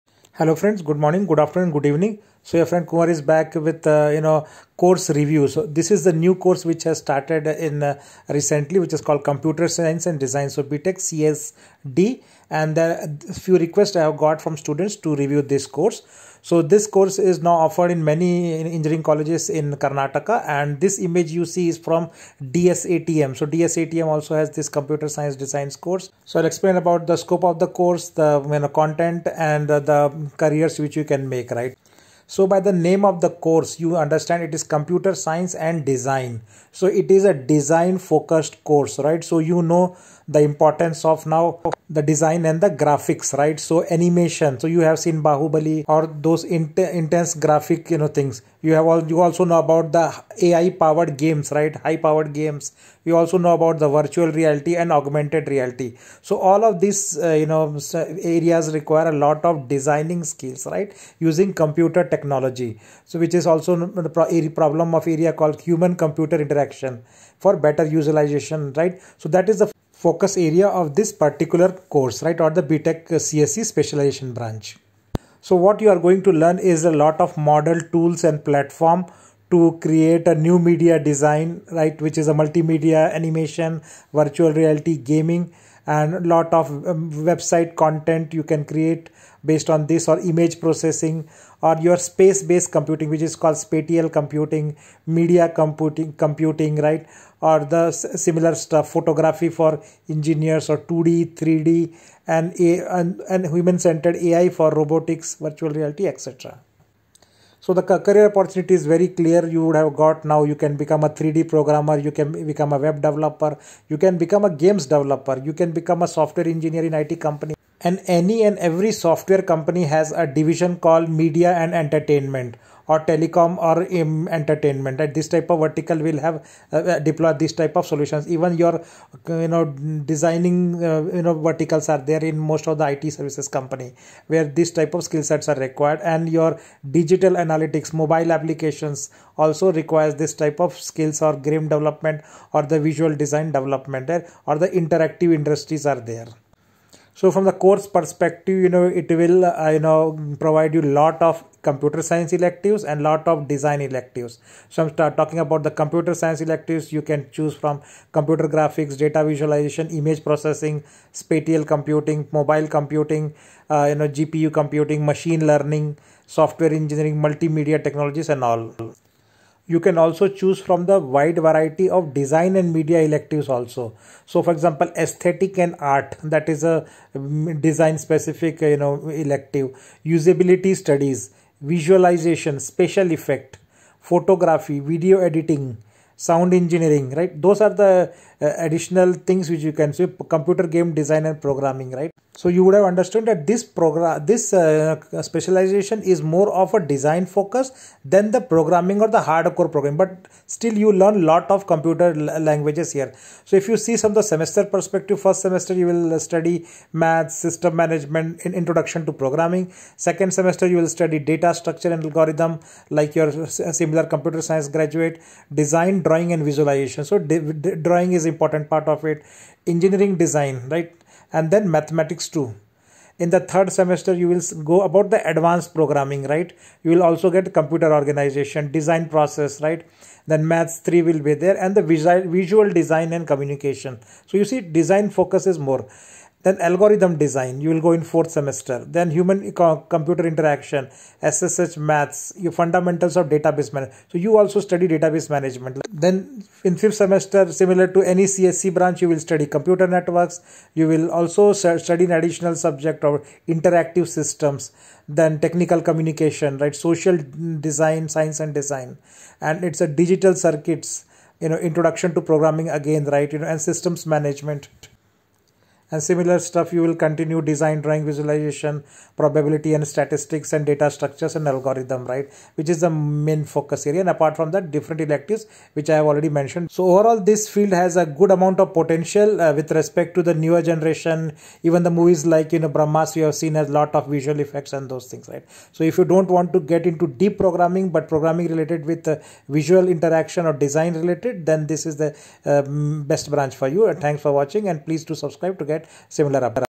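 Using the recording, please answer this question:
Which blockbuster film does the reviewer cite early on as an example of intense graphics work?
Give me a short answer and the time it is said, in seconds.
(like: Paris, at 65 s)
Bahubali, at 45 s.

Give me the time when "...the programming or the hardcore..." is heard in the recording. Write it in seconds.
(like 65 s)
198 s.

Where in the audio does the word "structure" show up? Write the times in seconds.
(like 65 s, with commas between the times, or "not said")
211 s, 270 s.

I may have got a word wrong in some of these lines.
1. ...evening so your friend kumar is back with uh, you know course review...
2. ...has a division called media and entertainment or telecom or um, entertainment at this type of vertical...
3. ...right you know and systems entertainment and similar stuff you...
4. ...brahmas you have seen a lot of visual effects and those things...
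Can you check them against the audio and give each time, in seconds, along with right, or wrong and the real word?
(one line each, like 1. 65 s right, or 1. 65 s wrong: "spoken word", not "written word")
1. 1 s right
2. 119 s right
3. 263 s wrong: "management", not "entertainment"
4. 282 s right.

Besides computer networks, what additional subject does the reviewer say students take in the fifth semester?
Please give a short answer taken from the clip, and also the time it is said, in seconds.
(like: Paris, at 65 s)
Interactive systems, at 253 s.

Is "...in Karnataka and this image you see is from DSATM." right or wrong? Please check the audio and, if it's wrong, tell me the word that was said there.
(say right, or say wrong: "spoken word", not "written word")
right.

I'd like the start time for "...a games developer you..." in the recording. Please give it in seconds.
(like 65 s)
114 s.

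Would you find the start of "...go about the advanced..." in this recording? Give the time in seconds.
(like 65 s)
224 s.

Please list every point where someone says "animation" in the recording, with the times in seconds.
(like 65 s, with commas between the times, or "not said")
43 s, 83 s.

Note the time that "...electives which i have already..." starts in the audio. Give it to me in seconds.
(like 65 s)
275 s.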